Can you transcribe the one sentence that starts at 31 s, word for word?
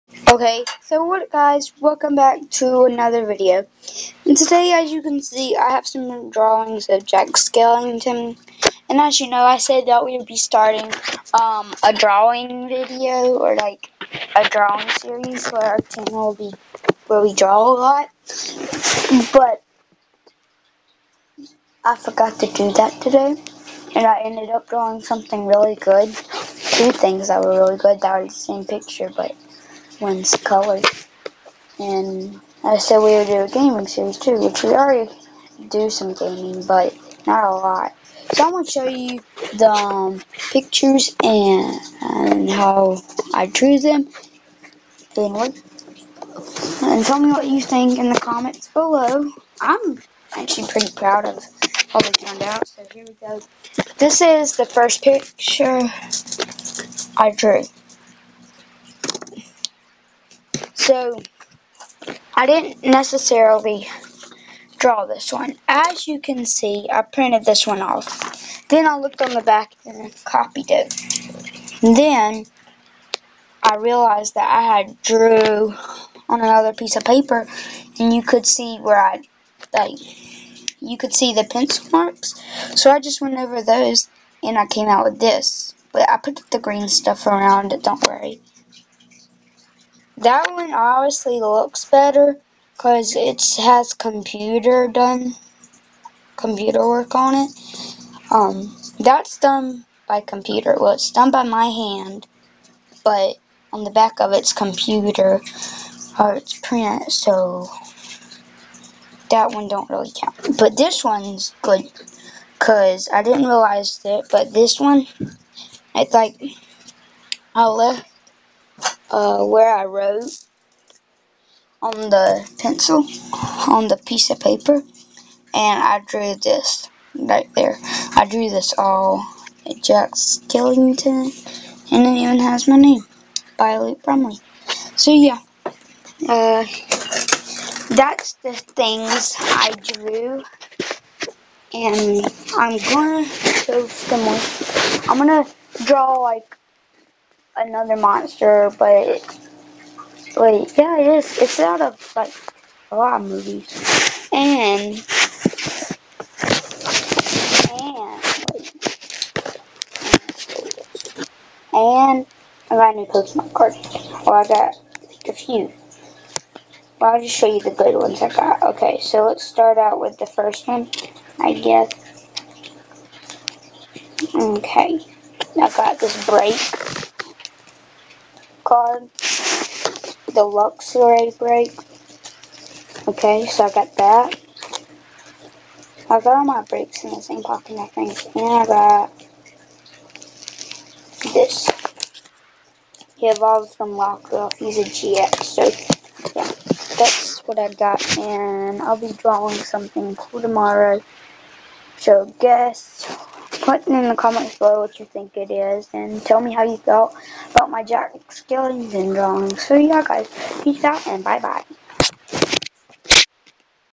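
And I said we would do a gaming series too, which we already do some gaming, but not a lot.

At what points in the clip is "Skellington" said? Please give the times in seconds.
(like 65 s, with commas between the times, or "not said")
7 s, 130 s, 208 s.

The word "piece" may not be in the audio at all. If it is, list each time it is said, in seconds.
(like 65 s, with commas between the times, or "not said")
76 s, 123 s.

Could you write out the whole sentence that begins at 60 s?
So I didn't necessarily draw this one.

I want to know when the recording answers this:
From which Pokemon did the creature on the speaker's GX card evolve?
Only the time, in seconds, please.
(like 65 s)
193 s.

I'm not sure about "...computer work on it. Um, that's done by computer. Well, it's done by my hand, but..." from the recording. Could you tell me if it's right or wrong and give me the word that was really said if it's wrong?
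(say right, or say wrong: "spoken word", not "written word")
right.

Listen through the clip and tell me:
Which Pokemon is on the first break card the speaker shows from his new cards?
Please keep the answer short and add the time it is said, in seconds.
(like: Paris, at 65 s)
Luxray, at 180 s.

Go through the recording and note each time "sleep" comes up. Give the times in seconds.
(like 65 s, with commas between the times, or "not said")
not said.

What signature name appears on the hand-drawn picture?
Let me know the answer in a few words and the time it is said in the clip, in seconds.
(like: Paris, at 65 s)
Luke Brumley, at 133 s.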